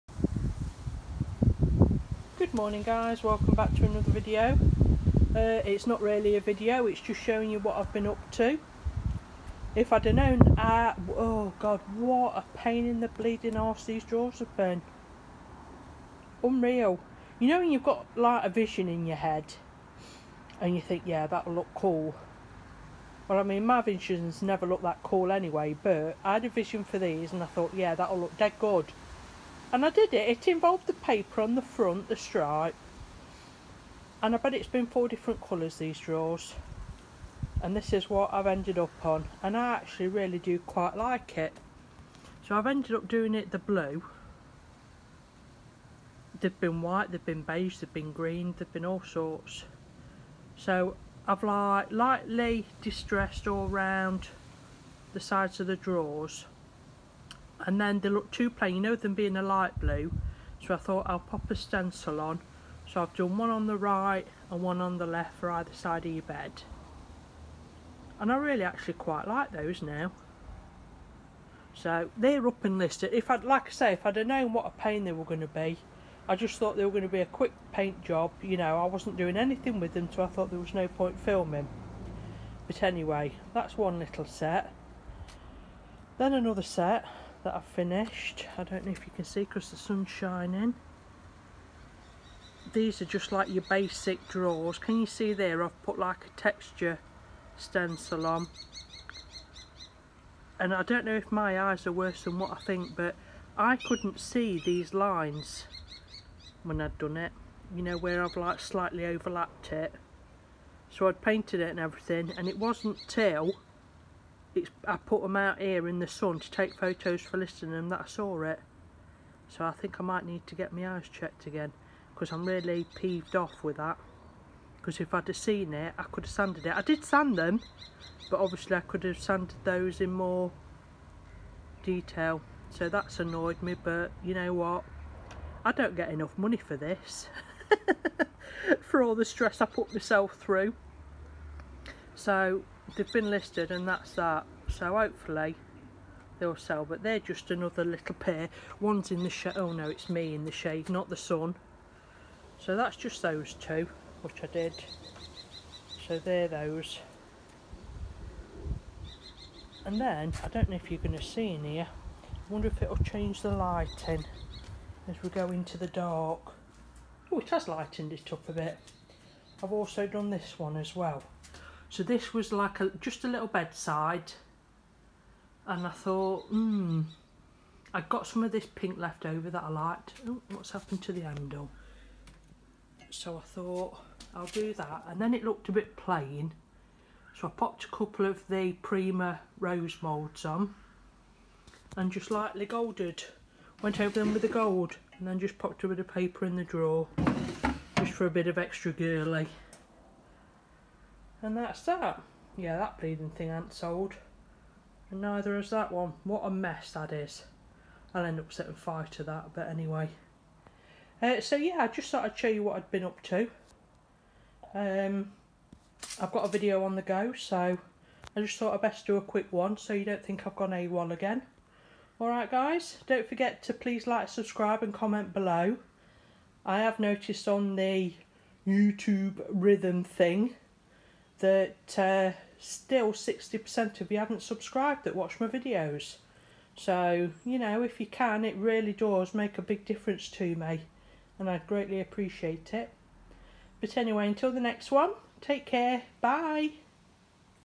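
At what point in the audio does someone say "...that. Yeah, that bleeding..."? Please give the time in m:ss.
3:21.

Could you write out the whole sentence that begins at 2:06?
I did sand them, but obviously I could have sanded those in more detail.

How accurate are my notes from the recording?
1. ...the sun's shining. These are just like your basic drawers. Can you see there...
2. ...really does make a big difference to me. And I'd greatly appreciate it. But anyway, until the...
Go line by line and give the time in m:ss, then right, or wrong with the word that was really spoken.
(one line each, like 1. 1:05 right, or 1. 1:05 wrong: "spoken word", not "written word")
1. 1:29 right
2. 3:58 right.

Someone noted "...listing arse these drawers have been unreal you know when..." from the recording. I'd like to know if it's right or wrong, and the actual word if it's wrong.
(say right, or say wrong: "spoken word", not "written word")
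wrong: "bleeding", not "listing".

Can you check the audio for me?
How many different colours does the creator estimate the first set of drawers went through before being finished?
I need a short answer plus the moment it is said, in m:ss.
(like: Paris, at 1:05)
4, at 0:34.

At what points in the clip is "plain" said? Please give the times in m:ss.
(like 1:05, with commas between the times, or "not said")
0:58, 3:05.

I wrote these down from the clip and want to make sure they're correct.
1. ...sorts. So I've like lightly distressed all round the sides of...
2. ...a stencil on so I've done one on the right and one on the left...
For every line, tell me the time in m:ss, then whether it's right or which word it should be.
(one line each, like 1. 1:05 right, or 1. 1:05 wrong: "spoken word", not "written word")
1. 0:49 right
2. 1:01 right.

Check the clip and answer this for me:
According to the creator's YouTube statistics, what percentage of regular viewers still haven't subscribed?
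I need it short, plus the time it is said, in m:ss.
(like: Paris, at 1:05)
60%, at 3:53.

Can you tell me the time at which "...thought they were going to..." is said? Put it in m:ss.
1:16.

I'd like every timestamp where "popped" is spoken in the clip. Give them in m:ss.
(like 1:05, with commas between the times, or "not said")
3:07, 3:15.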